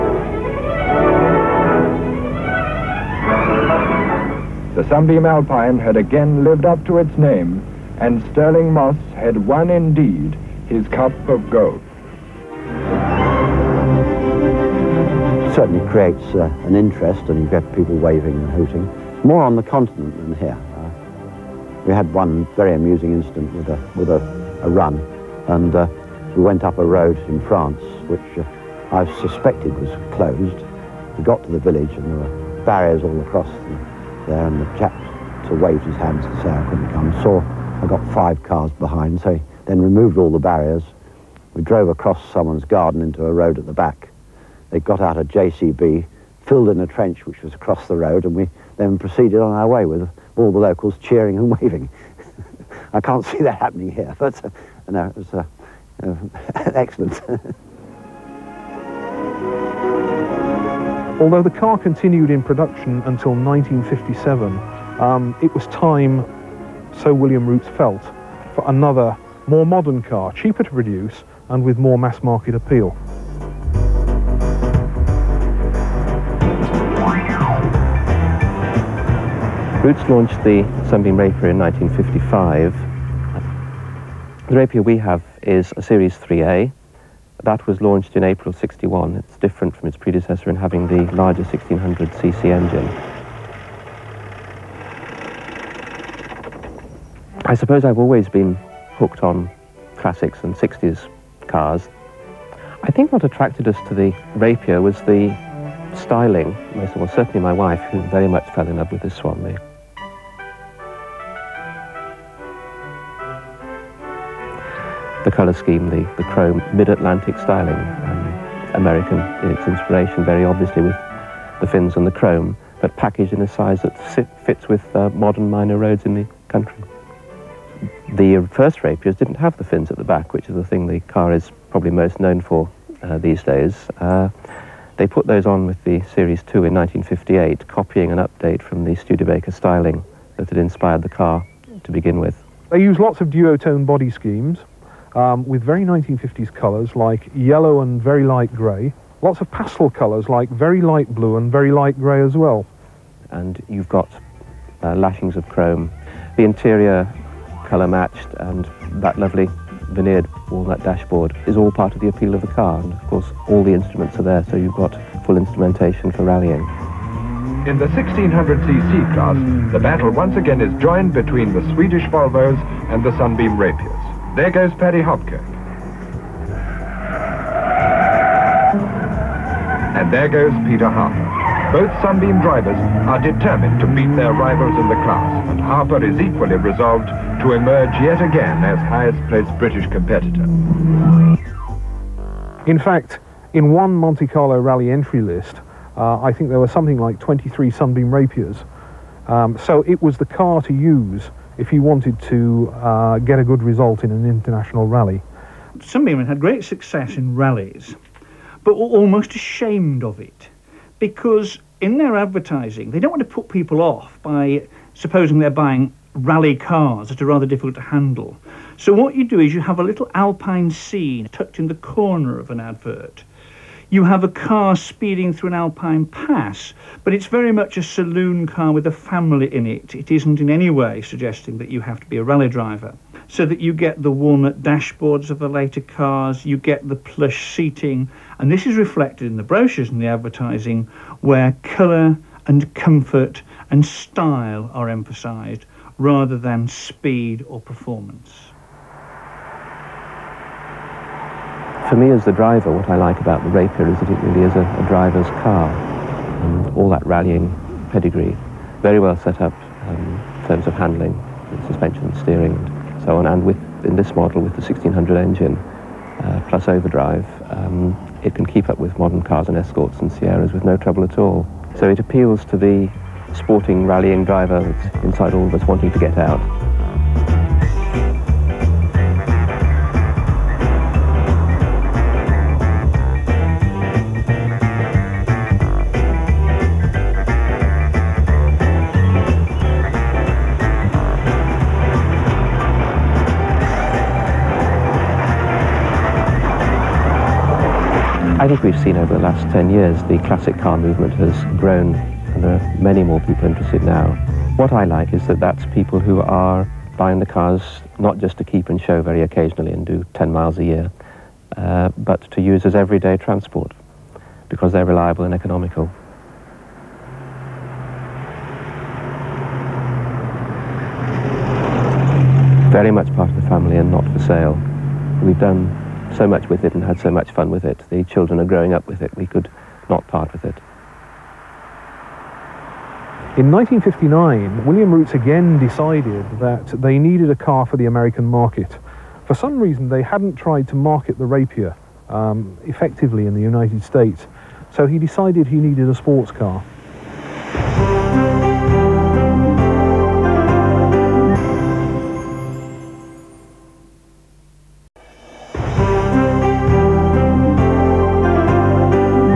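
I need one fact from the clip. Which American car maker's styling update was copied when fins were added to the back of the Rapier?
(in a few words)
Studebaker.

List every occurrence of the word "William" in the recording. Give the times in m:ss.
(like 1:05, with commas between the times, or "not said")
1:07, 5:34.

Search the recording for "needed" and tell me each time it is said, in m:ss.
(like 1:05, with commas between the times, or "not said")
5:36, 5:45.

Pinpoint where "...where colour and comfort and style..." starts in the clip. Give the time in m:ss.
4:01.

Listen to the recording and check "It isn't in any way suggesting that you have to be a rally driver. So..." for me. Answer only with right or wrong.
right.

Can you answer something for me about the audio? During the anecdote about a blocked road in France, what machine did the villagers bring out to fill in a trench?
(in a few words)
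JCB.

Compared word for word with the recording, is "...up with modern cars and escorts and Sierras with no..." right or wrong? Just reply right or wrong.
right.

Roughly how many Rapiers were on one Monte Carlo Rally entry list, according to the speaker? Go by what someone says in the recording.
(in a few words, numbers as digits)
23.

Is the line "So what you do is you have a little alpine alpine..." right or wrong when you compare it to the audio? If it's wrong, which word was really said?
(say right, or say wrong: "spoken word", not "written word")
wrong: "scene", not "alpine".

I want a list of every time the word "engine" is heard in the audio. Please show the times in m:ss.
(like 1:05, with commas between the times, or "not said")
1:32, 4:25.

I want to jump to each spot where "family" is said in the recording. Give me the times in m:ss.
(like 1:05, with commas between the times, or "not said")
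3:48, 5:23.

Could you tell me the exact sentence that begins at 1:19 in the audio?
Rootes launched the Sunbeam Rapier in 1955.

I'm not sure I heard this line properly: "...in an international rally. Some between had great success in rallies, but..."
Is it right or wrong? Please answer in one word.
wrong.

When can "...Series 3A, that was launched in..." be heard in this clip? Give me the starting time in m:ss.
1:25.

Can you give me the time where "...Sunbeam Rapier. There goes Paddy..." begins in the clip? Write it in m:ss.
2:53.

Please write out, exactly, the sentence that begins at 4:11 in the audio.
for me as the driver, what I like about the Rapier is that it really is a, a driver's car.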